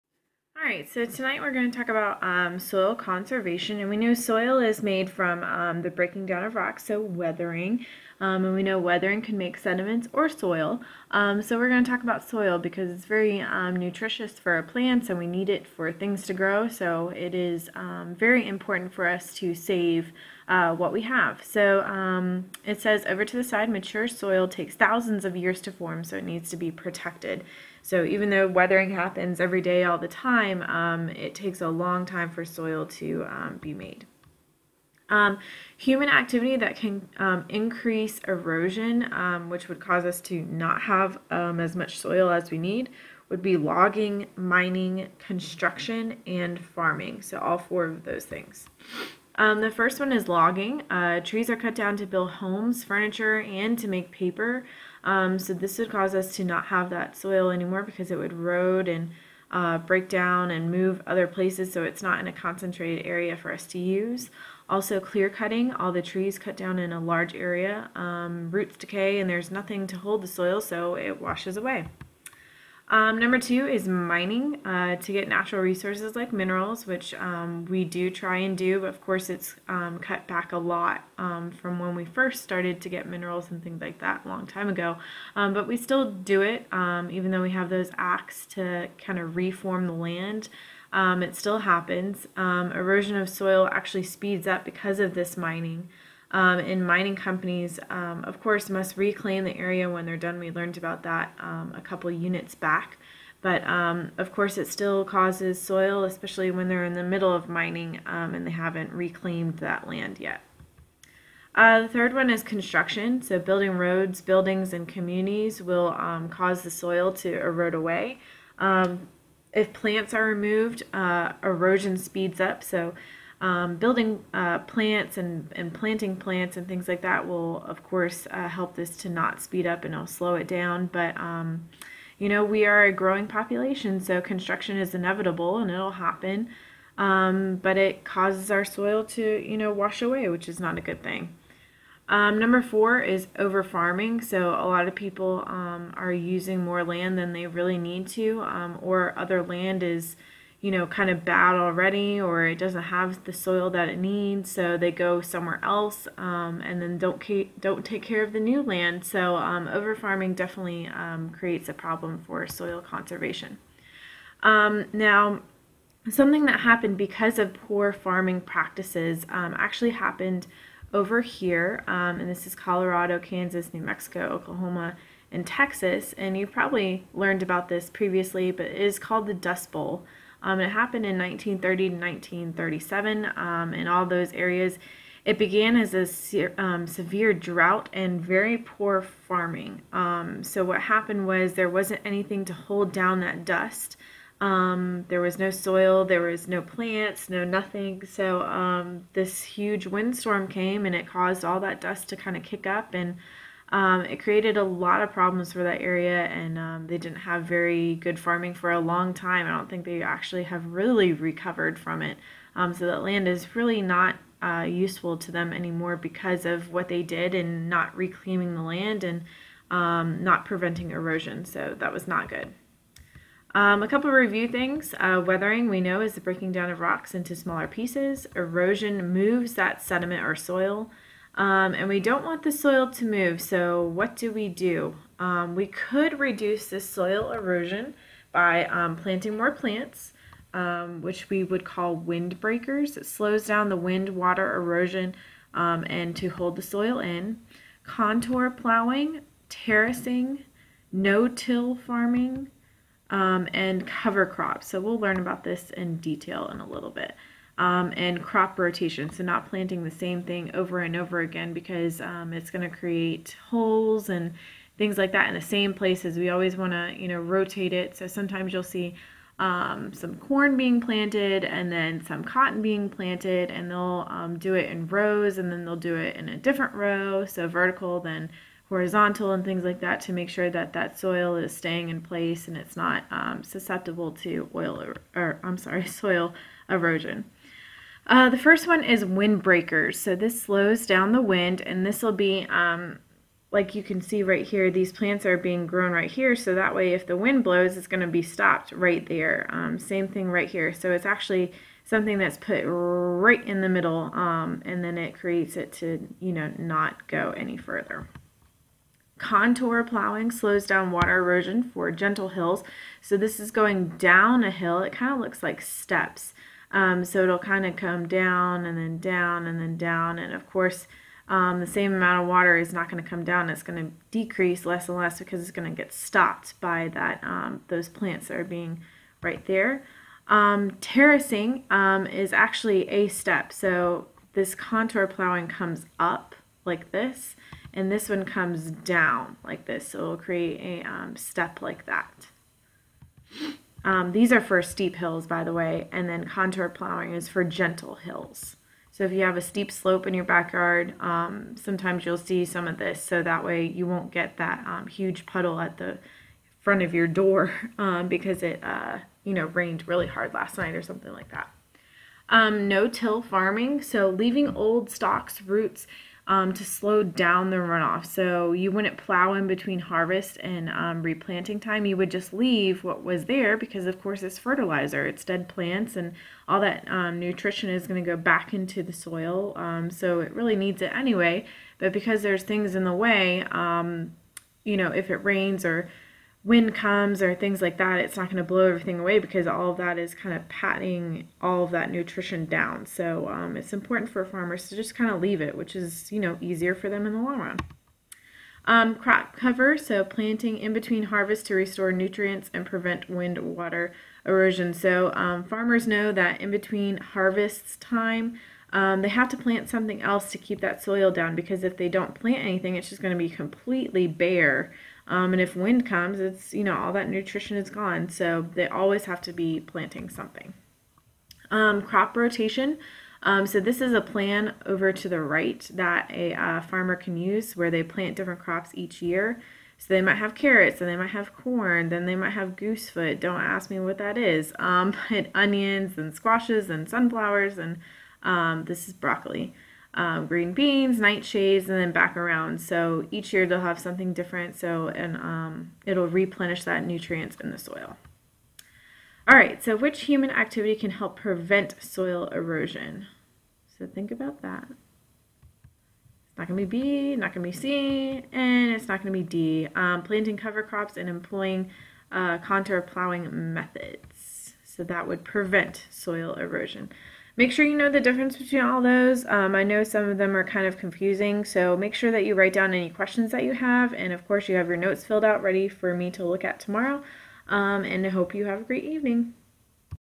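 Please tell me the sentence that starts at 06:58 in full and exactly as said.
So they always have to be planting something.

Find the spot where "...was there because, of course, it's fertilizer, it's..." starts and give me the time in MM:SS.
06:13.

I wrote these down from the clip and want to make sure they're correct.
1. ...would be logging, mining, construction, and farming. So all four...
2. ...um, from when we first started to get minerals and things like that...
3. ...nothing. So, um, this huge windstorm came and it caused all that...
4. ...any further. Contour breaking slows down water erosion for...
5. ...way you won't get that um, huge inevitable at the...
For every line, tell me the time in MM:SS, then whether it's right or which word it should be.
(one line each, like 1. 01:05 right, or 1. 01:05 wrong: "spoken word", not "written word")
1. 00:43 right
2. 01:21 right
3. 03:17 right
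4. 05:07 wrong: "plowing", not "breaking"
5. 05:53 wrong: "puddle", not "inevitable".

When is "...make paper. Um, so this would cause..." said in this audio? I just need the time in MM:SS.
00:53.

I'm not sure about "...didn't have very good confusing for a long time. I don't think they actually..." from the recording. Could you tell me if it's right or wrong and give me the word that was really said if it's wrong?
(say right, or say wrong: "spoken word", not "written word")
wrong: "farming", not "confusing".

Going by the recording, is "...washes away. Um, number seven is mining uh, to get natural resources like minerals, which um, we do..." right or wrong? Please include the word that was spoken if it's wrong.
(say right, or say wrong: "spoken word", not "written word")
wrong: "two", not "seven".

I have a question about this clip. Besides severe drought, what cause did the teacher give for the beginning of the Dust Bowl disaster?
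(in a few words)
very poor farming.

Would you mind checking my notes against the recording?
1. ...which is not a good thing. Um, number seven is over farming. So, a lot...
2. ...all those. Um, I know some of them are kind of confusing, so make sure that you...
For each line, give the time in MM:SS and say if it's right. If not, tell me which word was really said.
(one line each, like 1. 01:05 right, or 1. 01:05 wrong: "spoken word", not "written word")
1. 02:20 wrong: "four", not "seven"
2. 07:48 right.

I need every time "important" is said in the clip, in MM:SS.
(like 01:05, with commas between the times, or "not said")
00:18, 06:33.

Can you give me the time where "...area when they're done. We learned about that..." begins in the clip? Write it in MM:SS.
01:39.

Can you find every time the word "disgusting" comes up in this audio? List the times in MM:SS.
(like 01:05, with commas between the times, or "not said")
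not said.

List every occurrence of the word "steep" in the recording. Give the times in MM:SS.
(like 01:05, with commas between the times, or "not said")
05:44, 05:49.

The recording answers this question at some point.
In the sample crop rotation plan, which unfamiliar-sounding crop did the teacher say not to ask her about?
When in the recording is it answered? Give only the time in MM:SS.
07:12.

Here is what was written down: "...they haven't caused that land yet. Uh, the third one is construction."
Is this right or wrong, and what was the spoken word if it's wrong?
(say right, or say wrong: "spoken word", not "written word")
wrong: "reclaimed", not "caused".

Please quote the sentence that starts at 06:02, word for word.
Um, no-till farming, so leaving old stalks, roots, um, to slow down the runoff.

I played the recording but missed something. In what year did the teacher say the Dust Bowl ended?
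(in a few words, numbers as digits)
1937.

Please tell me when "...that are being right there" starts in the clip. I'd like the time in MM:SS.
05:28.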